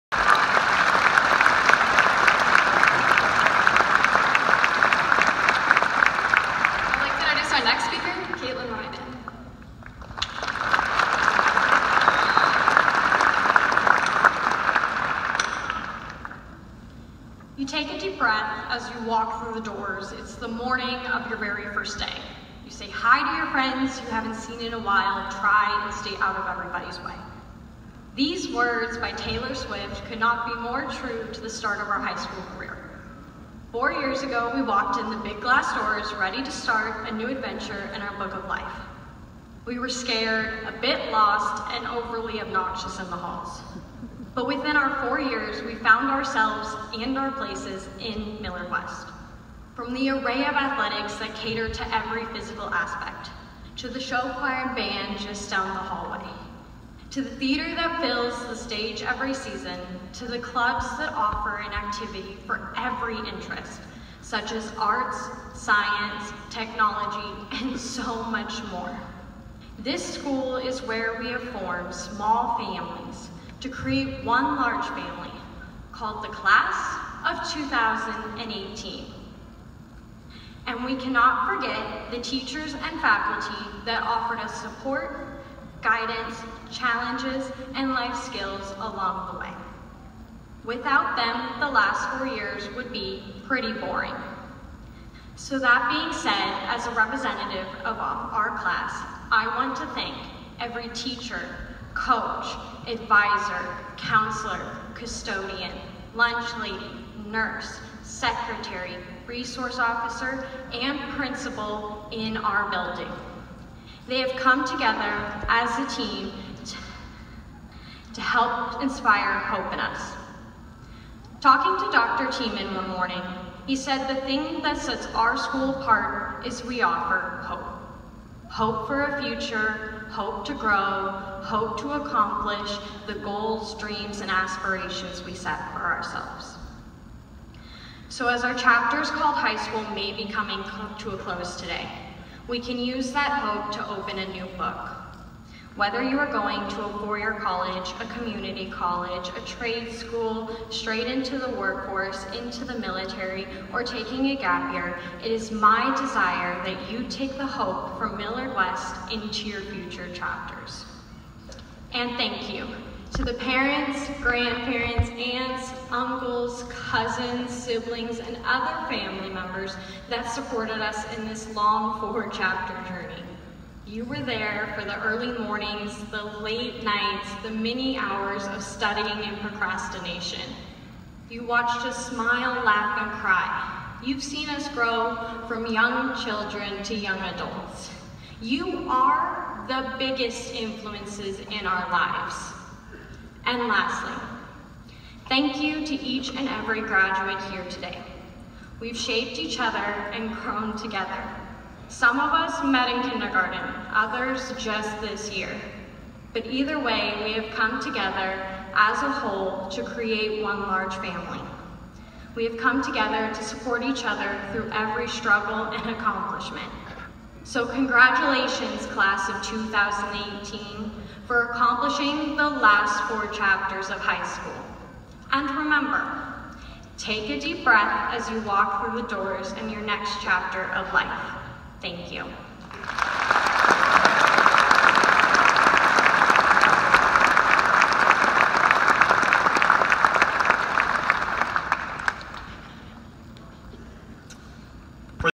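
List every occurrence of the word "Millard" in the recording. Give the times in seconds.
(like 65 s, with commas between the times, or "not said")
48 s, 158 s.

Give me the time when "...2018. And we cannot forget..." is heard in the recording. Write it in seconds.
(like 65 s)
77 s.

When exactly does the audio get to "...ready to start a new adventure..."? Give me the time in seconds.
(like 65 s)
36 s.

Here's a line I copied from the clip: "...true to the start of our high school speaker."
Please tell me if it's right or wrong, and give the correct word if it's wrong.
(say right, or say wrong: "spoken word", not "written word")
wrong: "career", not "speaker".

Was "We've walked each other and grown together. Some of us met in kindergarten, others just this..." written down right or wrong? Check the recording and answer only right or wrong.
wrong.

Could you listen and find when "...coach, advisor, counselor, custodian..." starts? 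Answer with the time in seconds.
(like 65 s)
101 s.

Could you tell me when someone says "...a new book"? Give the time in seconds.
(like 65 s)
144 s.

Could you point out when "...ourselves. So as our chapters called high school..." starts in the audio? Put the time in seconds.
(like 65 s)
135 s.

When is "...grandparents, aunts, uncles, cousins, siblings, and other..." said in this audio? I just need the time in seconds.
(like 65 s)
164 s.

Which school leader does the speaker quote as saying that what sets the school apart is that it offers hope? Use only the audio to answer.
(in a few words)
Dr. Tiemann.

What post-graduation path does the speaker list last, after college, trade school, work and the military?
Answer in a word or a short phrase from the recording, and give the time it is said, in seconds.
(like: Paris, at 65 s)
gap year, at 154 s.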